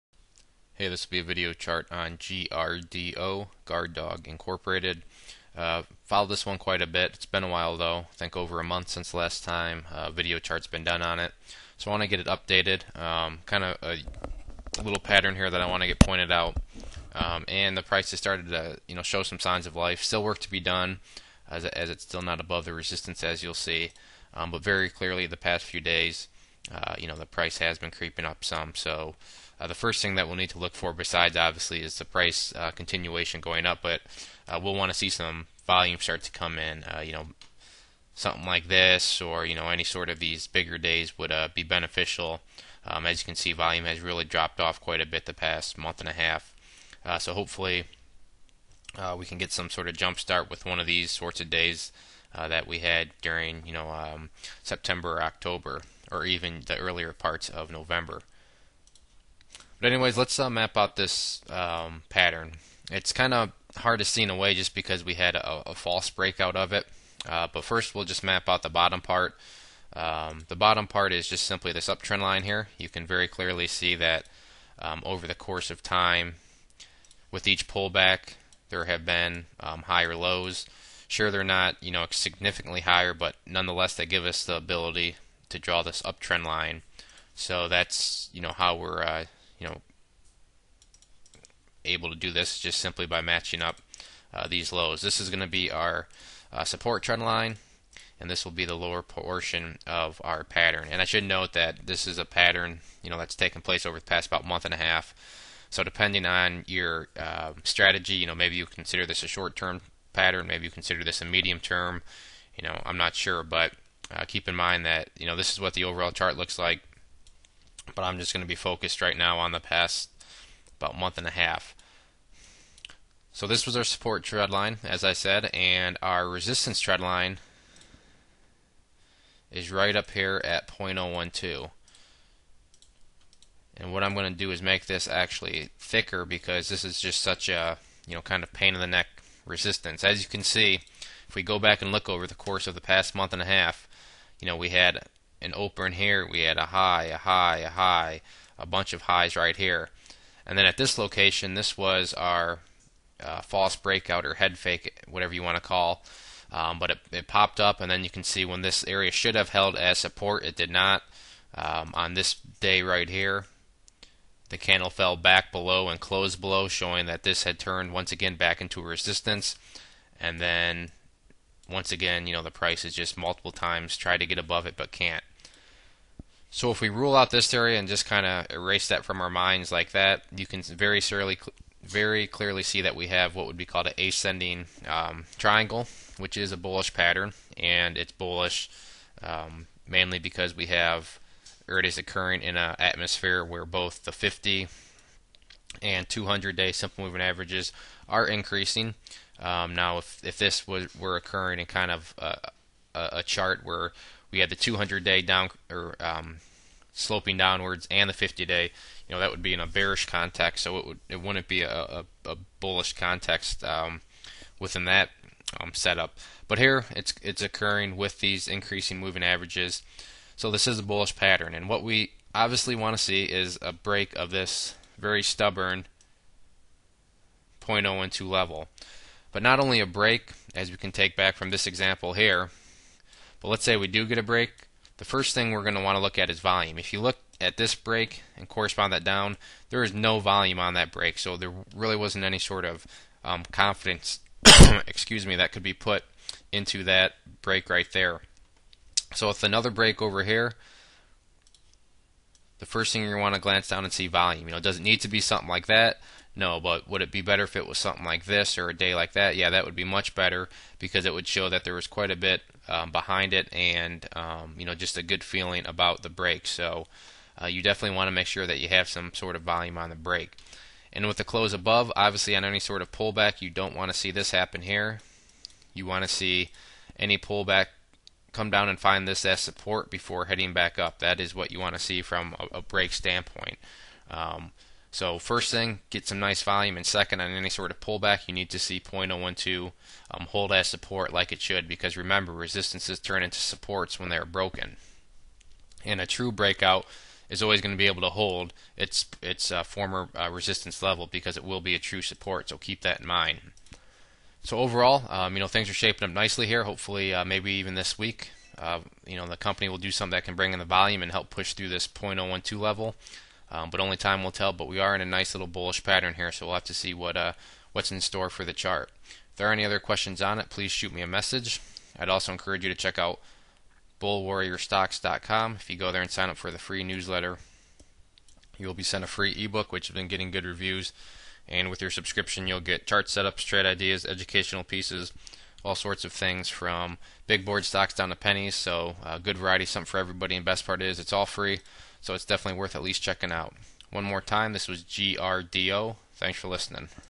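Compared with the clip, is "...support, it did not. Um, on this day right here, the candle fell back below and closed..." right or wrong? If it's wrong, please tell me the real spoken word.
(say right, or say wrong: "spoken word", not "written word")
right.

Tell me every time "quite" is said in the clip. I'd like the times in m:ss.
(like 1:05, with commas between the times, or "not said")
0:06, 0:44, 4:21.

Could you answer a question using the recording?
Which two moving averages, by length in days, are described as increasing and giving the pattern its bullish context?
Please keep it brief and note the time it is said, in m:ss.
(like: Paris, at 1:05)
50 and 200-day, at 3:14.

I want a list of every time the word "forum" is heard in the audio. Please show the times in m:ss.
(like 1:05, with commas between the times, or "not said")
not said.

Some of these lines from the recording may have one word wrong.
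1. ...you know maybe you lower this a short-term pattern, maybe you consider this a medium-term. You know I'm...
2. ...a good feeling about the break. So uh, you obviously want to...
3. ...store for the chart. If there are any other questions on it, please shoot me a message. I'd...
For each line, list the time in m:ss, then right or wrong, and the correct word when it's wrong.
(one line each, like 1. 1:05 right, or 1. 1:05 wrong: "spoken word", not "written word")
1. 1:48 wrong: "consider", not "lower"
2. 4:24 wrong: "definitely", not "obviously"
3. 5:18 right.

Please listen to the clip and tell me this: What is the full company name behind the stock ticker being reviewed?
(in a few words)
Guard Dog Incorporated.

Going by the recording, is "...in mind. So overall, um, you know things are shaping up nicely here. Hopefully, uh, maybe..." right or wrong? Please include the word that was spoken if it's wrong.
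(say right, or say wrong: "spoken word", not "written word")
right.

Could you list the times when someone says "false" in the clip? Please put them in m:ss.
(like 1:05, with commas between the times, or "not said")
1:05, 2:33.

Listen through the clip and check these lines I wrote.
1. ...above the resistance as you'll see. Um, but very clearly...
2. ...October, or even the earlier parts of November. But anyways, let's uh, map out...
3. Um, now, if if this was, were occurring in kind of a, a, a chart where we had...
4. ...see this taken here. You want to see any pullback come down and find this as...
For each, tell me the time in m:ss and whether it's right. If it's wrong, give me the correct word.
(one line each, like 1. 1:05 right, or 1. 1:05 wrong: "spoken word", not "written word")
1. 0:22 right
2. 0:55 right
3. 3:19 right
4. 4:33 wrong: "happen", not "taken".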